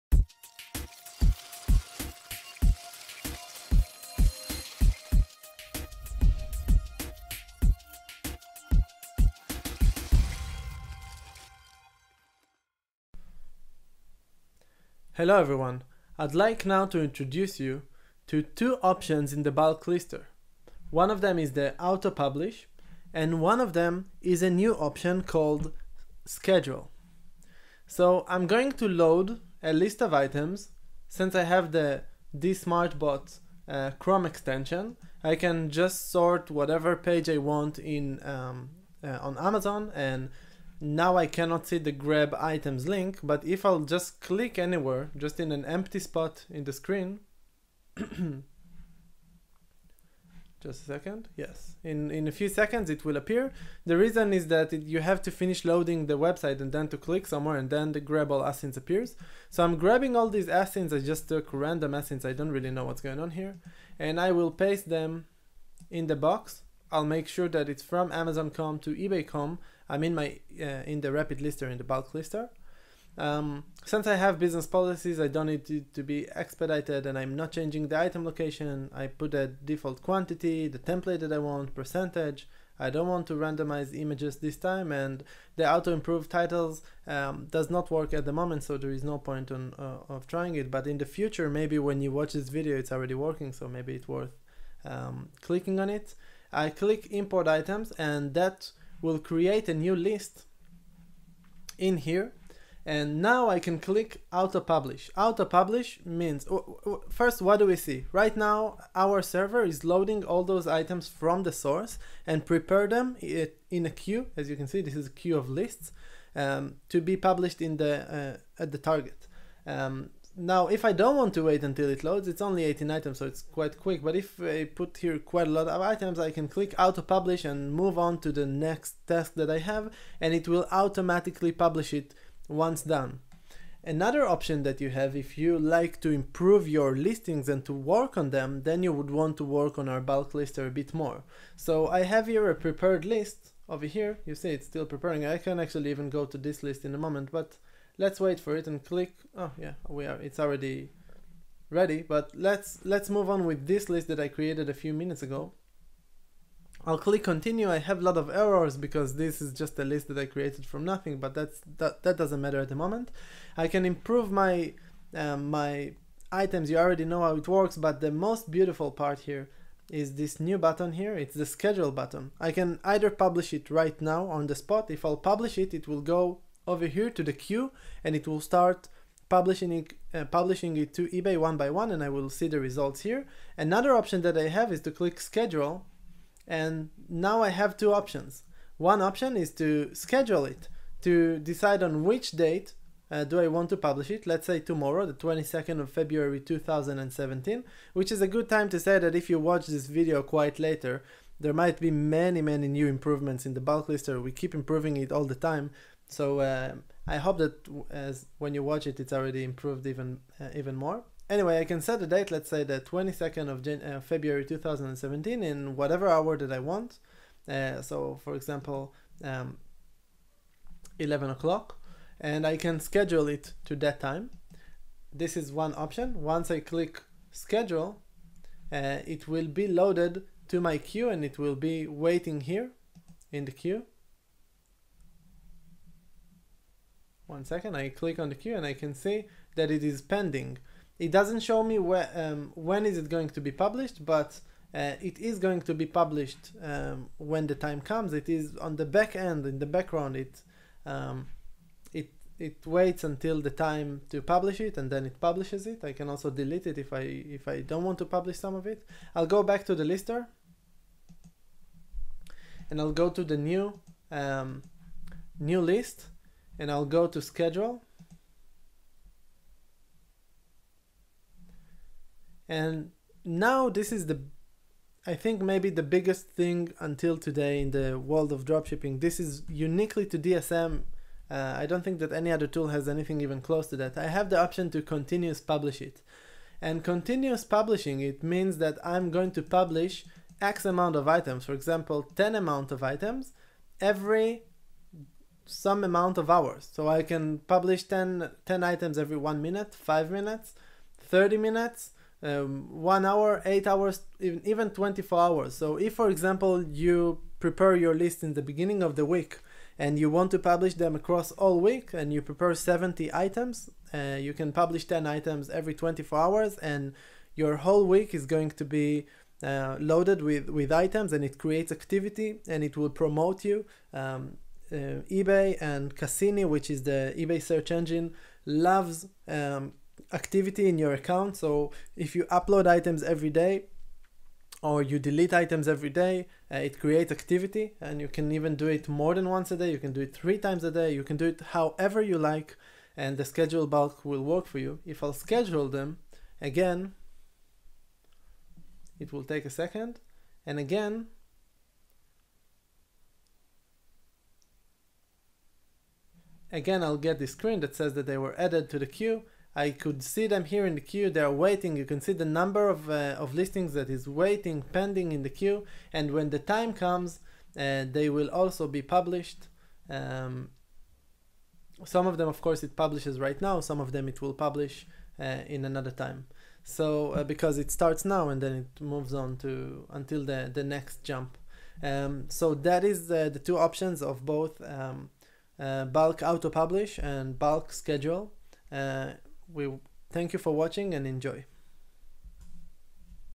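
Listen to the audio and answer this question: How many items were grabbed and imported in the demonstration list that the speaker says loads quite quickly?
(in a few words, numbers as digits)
18.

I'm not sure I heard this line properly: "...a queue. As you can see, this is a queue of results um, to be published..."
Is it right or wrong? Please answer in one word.
wrong.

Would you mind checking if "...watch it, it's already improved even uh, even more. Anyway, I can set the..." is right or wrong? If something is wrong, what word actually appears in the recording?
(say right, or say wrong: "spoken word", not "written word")
right.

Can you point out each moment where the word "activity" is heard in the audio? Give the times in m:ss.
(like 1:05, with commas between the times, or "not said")
5:21, 5:30, 5:37.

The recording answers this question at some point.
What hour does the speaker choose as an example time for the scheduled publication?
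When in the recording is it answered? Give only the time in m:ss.
3:40.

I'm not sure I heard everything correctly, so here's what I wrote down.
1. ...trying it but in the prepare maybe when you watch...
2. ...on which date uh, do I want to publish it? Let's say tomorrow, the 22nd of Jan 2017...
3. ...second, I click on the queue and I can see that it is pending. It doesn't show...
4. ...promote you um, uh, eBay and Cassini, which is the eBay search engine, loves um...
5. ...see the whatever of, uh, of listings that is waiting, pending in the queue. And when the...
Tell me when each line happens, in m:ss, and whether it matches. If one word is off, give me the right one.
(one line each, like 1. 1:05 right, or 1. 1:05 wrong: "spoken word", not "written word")
1. 1:30 wrong: "future", not "prepare"
2. 3:11 wrong: "February", not "Jan"
3. 3:57 right
4. 5:22 right
5. 6:02 wrong: "number", not "whatever".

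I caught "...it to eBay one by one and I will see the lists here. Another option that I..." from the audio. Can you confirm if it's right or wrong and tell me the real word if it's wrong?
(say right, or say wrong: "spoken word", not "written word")
wrong: "results", not "lists".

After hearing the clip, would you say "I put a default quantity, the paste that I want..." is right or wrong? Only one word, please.
wrong.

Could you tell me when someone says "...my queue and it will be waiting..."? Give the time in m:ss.
3:50.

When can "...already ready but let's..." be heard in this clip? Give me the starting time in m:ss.
2:30.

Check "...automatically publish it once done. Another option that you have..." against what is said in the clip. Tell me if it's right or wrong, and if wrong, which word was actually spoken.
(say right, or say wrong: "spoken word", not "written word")
right.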